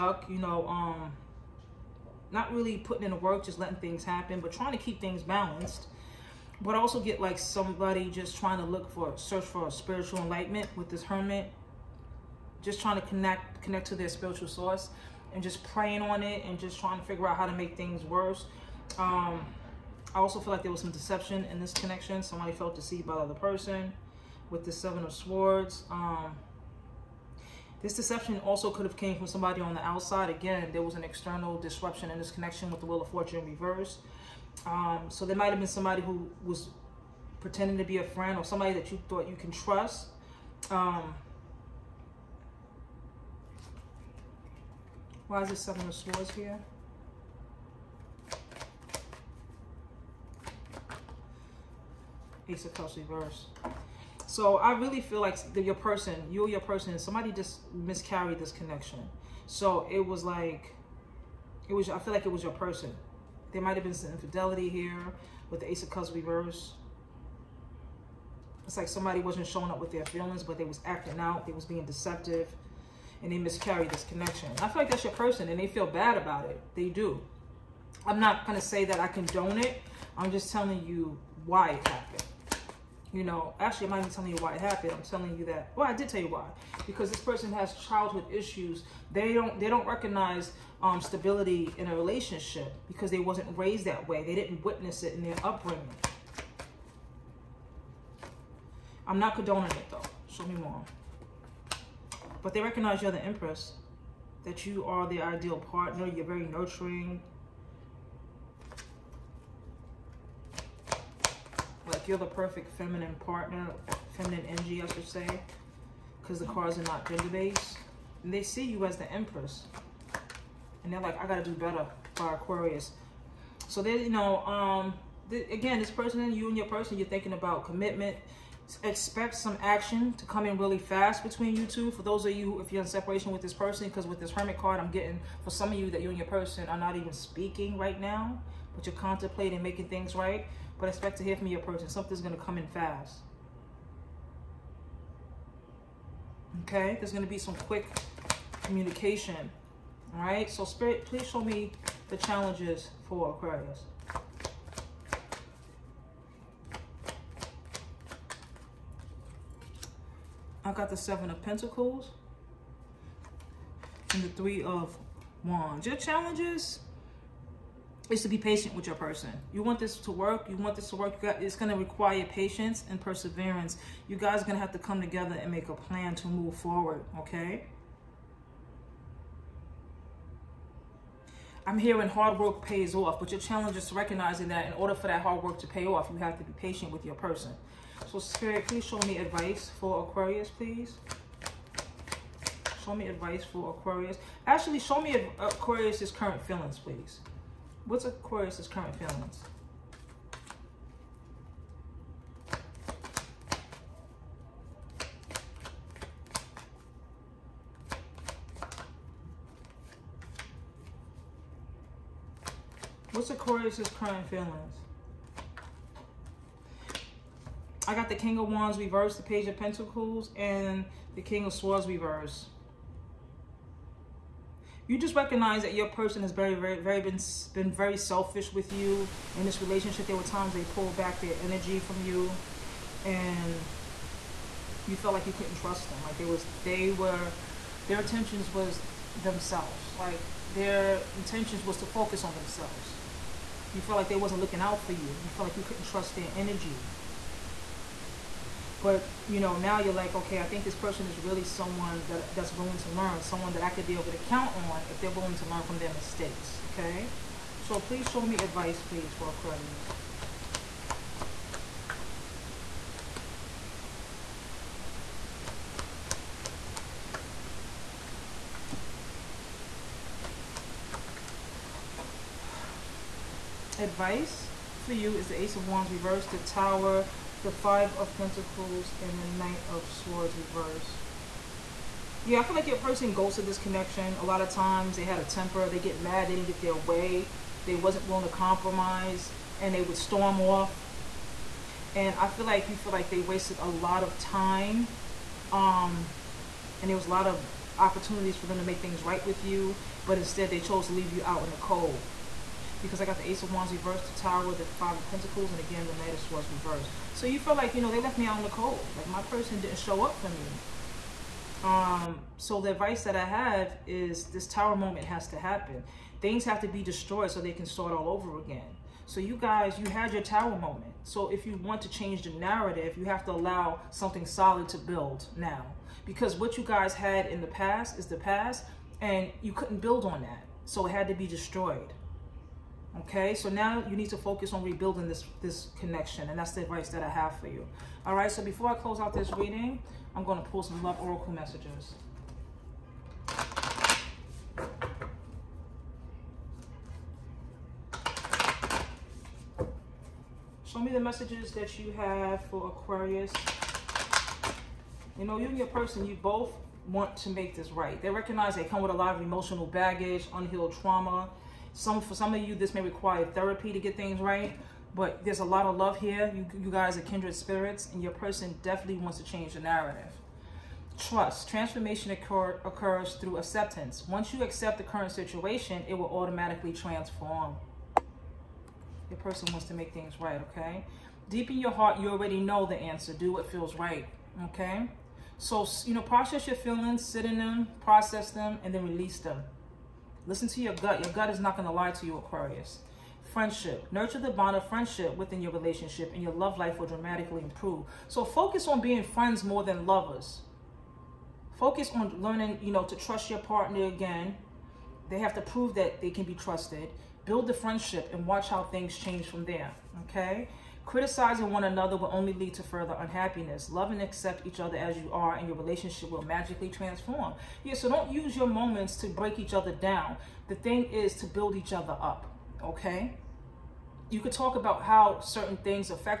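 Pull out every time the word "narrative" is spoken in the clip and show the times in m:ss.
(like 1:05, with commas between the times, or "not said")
5:22, 6:09.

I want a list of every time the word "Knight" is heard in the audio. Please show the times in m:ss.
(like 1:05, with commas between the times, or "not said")
4:39, 5:05.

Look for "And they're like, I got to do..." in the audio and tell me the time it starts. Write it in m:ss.
2:00.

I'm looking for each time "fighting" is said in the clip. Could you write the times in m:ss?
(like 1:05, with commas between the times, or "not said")
not said.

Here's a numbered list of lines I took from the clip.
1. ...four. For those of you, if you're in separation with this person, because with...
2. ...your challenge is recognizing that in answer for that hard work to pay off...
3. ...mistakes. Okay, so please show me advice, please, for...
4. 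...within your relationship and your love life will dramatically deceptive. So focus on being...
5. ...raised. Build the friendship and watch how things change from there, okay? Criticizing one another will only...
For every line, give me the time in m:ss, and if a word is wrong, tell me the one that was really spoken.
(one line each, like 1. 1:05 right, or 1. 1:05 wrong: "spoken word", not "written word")
1. 2:11 wrong: "two", not "four"
2. 3:03 wrong: "order", not "answer"
3. 4:15 right
4. 6:35 wrong: "improve", not "deceptive"
5. 6:46 wrong: "trusted", not "raised".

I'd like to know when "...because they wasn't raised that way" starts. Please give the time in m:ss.
1:32.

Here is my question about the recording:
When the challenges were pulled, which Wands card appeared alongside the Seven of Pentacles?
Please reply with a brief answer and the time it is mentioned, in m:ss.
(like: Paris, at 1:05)
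Three of Wands, at 2:44.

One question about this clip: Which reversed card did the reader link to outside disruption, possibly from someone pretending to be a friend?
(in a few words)
Wheel of Fortune.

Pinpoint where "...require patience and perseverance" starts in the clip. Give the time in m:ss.
2:51.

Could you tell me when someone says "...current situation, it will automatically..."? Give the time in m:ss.
6:14.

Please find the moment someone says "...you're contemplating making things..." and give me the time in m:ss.
2:18.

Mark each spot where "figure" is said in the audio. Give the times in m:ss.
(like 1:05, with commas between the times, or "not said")
0:17.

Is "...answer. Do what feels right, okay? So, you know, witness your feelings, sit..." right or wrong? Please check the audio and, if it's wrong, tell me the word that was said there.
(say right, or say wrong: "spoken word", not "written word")
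wrong: "process", not "witness".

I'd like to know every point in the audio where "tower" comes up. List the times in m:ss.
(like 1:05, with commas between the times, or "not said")
4:36, 5:04, 5:14, 5:20.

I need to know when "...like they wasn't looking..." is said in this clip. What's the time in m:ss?
4:03.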